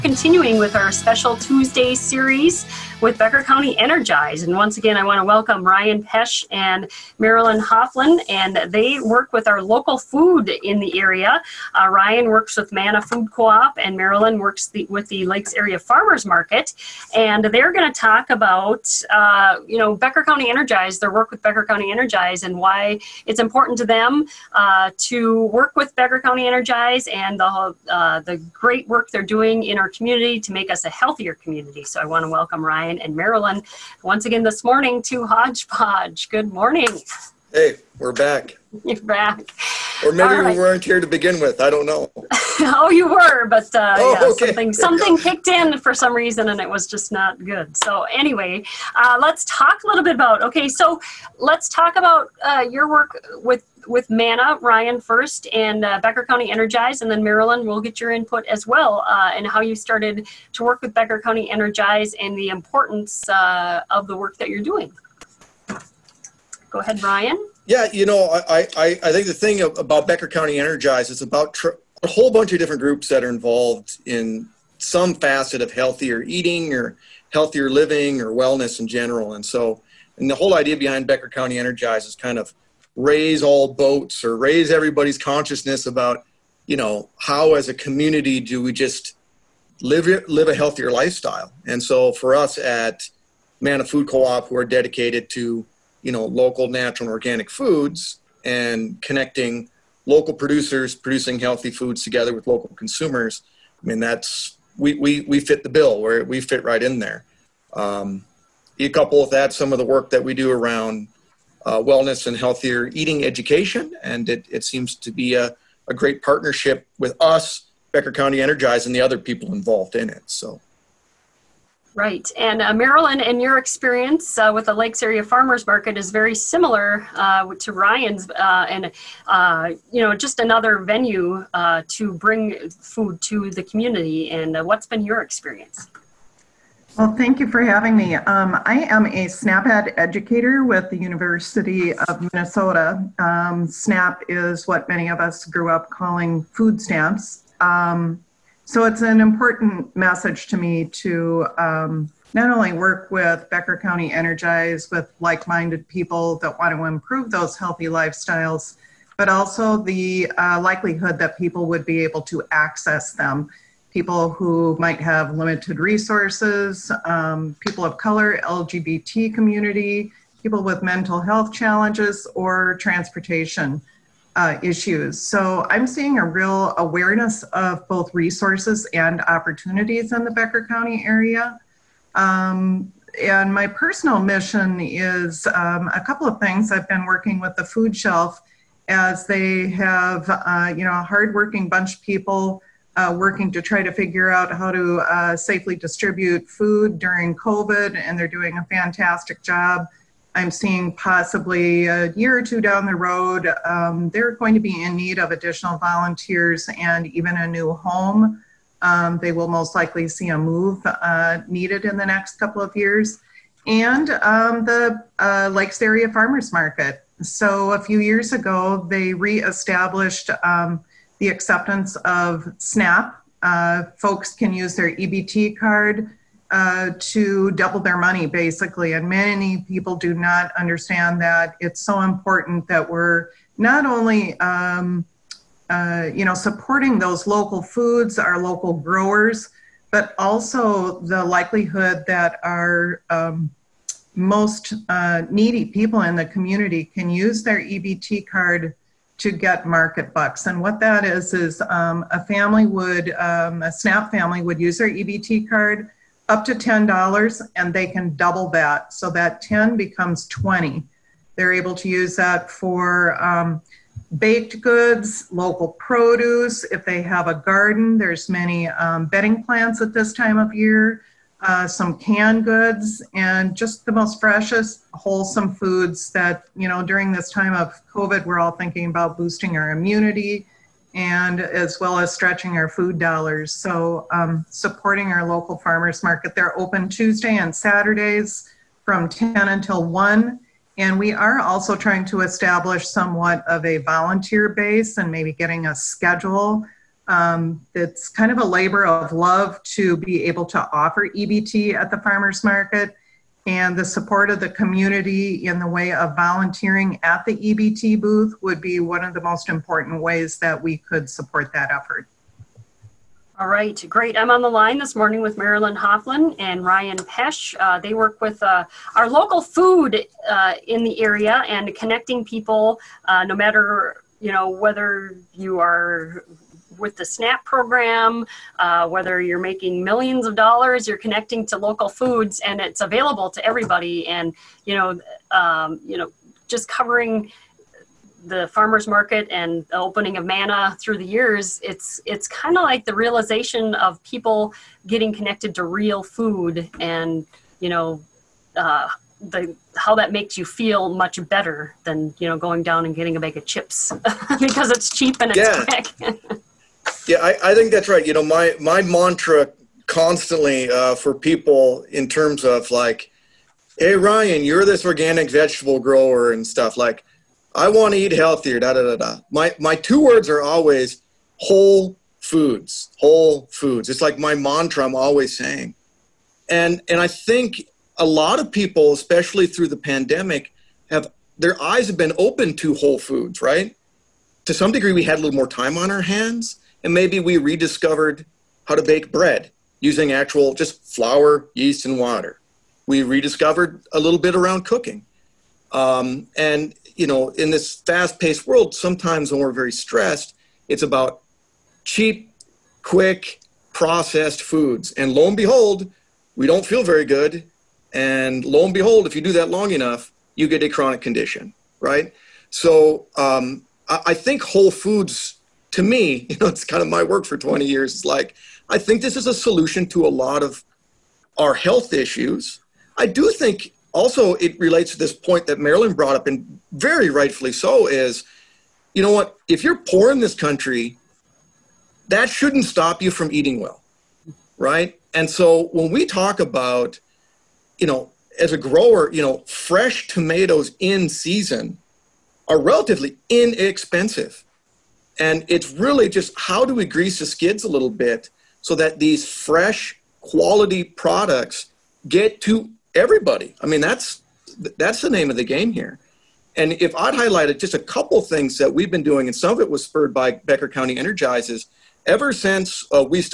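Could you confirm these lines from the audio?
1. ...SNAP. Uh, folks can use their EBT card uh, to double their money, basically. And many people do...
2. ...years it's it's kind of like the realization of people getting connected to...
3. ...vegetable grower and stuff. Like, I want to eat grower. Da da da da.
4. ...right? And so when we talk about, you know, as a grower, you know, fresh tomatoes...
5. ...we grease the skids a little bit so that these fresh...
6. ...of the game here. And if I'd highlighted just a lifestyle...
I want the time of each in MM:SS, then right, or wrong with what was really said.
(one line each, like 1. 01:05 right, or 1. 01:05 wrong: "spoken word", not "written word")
1. 03:42 right
2. 05:41 right
3. 06:05 wrong: "healthier", not "grower"
4. 07:14 right
5. 07:26 right
6. 07:35 wrong: "couple", not "lifestyle".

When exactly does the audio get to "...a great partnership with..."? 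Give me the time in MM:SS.
01:55.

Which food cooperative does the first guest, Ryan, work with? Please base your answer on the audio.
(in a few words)
Manna Food Co-op.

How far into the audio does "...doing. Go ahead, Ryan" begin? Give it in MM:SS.
01:04.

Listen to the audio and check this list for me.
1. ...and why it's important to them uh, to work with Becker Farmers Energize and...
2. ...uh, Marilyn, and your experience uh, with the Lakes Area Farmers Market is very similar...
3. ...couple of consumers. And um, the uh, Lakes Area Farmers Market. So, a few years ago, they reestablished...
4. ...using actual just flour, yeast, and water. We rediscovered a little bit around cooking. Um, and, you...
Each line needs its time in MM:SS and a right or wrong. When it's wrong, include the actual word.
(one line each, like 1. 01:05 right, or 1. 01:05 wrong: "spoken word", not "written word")
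1. 00:22 wrong: "County", not "Farmers"
2. 02:02 right
3. 03:32 wrong: "years", not "consumers"
4. 06:29 right.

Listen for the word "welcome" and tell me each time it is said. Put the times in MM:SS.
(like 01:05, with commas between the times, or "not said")
00:05, 00:32.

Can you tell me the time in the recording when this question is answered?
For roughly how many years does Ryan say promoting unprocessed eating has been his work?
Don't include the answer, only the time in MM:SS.
06:57.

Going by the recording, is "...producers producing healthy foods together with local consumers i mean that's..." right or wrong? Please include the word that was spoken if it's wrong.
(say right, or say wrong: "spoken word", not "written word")
right.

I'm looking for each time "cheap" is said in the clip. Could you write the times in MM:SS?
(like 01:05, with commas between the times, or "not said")
05:54, 06:41.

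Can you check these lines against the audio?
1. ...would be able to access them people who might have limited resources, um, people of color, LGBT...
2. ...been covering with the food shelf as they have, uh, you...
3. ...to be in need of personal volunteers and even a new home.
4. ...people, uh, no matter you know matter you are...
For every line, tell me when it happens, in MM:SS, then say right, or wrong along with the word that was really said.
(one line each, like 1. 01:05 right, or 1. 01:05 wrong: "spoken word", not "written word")
1. 02:41 right
2. 03:06 wrong: "working", not "covering"
3. 03:24 wrong: "additional", not "personal"
4. 05:22 wrong: "whether", not "matter".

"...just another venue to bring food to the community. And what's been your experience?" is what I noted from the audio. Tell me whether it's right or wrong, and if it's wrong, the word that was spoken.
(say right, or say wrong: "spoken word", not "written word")
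right.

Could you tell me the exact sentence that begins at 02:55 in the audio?
So I'm seeing a real awareness of both resources and opportunities in the Becker County area.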